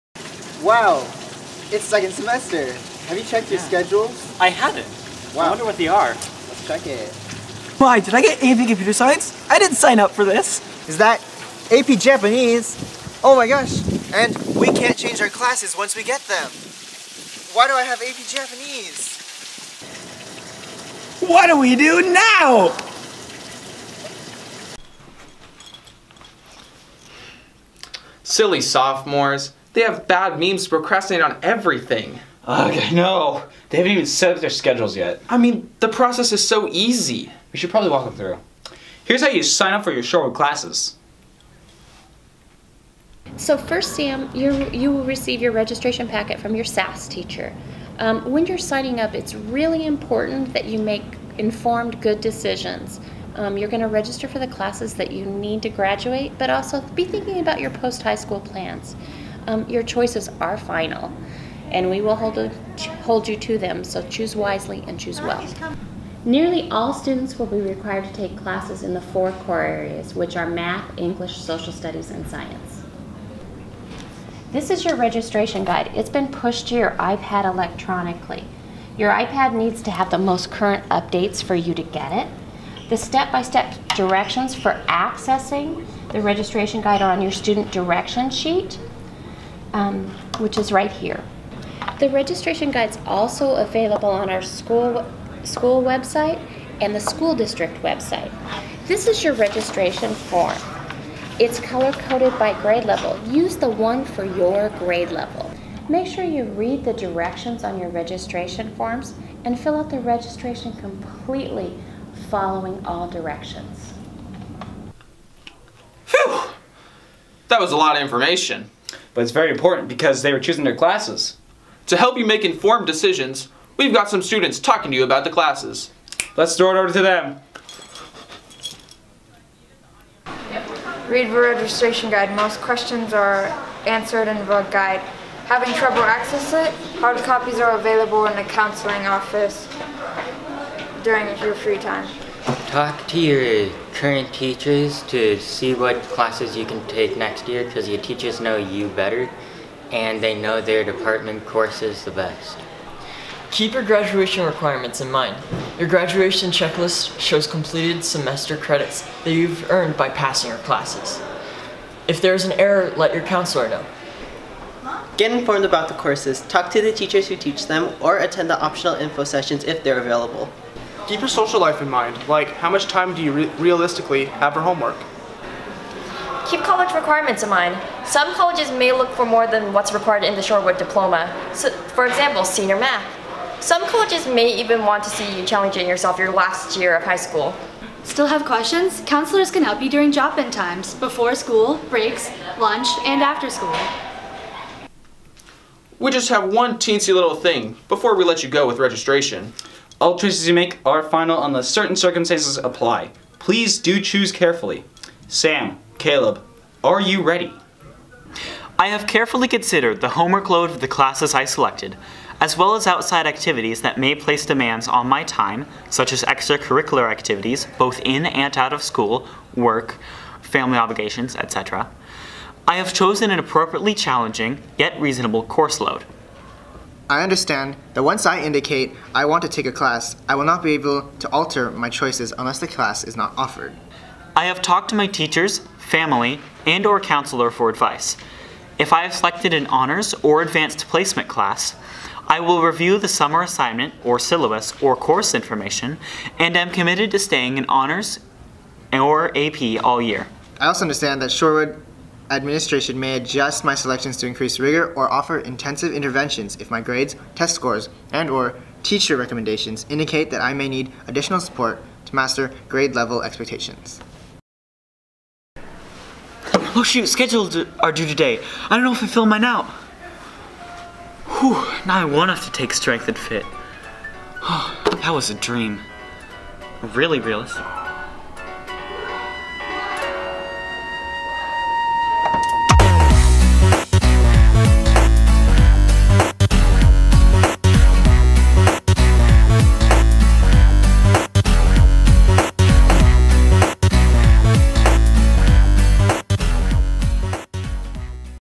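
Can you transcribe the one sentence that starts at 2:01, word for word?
To help you make informed decisions, we've got some students talking to you about the classes.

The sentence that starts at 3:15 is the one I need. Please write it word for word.
We just have one teensy little thing before we let you go with registration.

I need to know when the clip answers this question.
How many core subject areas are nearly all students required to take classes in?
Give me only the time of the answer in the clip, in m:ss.
1:09.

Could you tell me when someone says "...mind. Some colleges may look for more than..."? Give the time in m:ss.
2:57.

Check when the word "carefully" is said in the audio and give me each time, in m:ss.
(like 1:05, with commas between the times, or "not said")
3:24, 3:29.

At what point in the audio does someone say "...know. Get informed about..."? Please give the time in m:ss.
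2:43.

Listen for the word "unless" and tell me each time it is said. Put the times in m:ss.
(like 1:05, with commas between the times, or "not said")
3:21, 3:52.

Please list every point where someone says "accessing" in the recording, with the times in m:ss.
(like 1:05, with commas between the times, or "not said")
1:24, 2:16.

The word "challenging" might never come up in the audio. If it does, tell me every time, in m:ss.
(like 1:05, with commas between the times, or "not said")
3:05, 3:43.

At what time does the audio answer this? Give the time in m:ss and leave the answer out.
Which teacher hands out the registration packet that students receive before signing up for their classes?
0:46.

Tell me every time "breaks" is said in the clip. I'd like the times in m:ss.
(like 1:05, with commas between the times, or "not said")
3:11.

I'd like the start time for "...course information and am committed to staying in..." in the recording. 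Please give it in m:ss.
4:04.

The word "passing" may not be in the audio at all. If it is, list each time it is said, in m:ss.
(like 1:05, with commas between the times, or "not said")
2:40.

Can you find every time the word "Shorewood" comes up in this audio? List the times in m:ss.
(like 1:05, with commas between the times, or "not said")
0:40, 3:00, 4:11.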